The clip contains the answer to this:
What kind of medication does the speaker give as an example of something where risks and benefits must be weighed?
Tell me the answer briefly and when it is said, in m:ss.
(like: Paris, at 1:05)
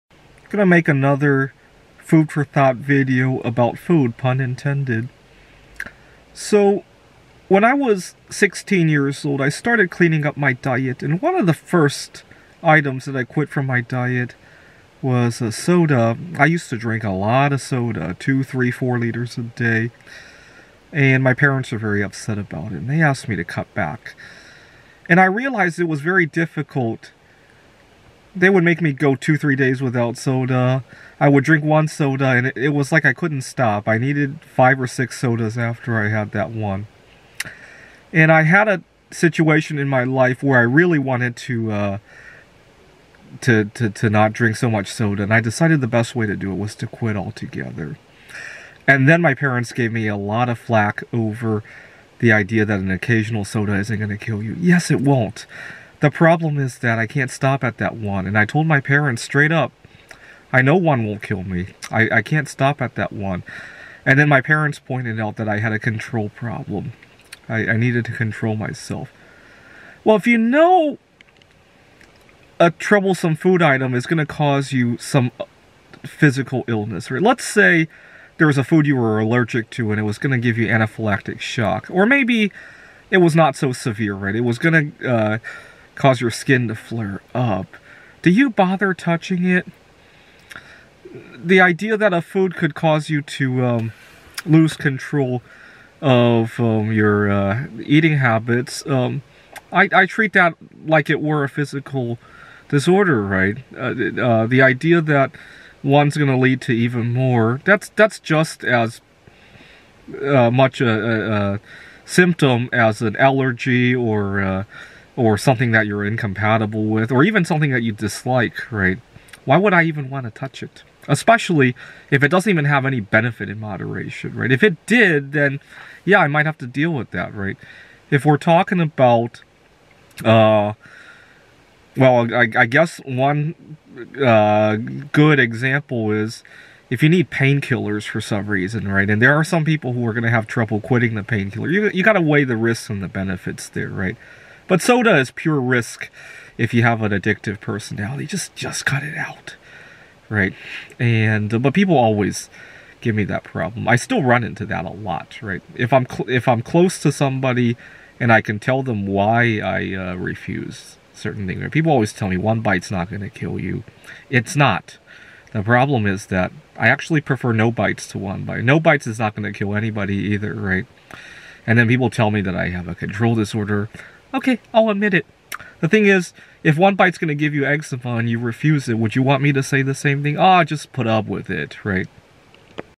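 Painkillers, at 2:17.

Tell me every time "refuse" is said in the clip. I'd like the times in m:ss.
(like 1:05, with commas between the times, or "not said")
2:40, 2:58.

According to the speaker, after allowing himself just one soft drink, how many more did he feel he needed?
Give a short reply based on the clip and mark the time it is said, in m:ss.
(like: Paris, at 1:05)
5 or 6, at 0:34.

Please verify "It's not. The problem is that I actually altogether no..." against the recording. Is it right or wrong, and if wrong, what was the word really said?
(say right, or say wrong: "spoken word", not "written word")
wrong: "prefer", not "altogether".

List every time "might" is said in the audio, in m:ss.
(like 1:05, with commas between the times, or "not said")
2:06.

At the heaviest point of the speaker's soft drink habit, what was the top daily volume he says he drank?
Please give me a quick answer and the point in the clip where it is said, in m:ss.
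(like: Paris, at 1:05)
4 liters, at 0:18.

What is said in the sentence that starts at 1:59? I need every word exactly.
Why would I even want to touch it?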